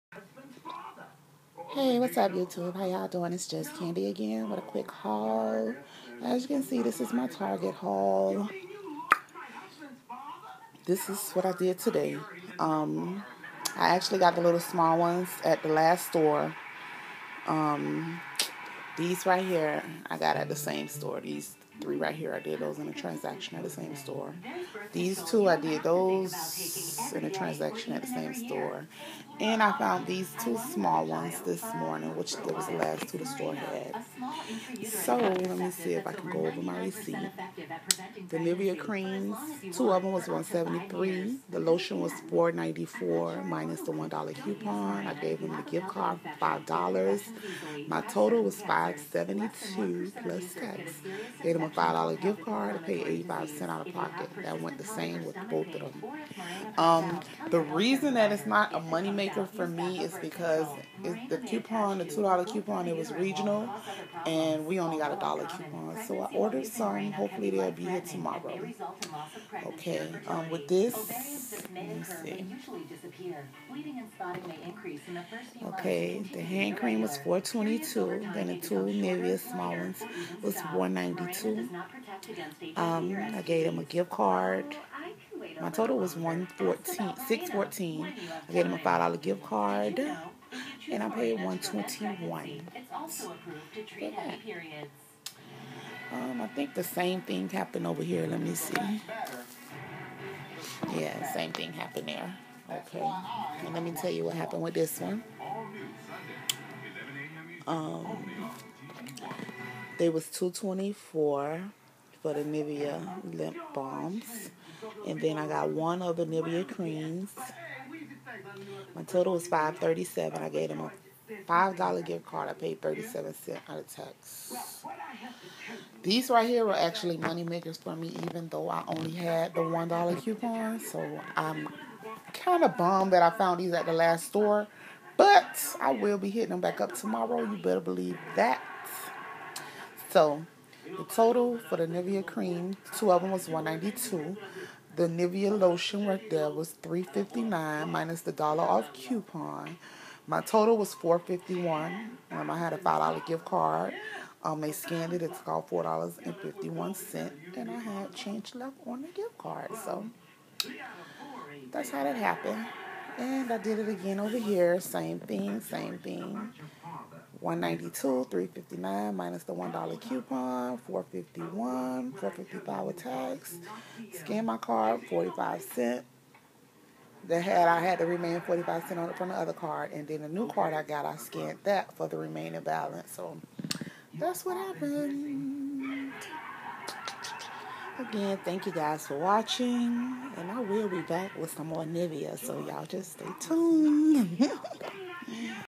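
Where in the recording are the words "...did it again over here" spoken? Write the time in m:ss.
2:43.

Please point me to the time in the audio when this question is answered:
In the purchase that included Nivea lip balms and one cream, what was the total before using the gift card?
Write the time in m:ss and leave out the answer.
1:59.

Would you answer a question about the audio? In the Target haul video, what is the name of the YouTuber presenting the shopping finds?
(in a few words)
Jus Candy.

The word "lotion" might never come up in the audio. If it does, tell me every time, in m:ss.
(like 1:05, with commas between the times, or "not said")
0:41, 2:25.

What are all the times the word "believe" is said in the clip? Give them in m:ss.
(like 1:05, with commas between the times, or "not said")
2:17.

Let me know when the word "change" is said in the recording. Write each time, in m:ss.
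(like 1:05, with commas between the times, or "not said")
2:38.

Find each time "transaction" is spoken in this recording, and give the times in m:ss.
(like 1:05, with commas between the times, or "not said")
0:22, 0:27.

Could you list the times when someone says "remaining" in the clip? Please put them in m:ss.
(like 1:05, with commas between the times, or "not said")
2:58, 3:02.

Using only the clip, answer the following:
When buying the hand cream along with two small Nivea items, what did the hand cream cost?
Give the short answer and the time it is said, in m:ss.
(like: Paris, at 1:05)
$4.22, at 1:17.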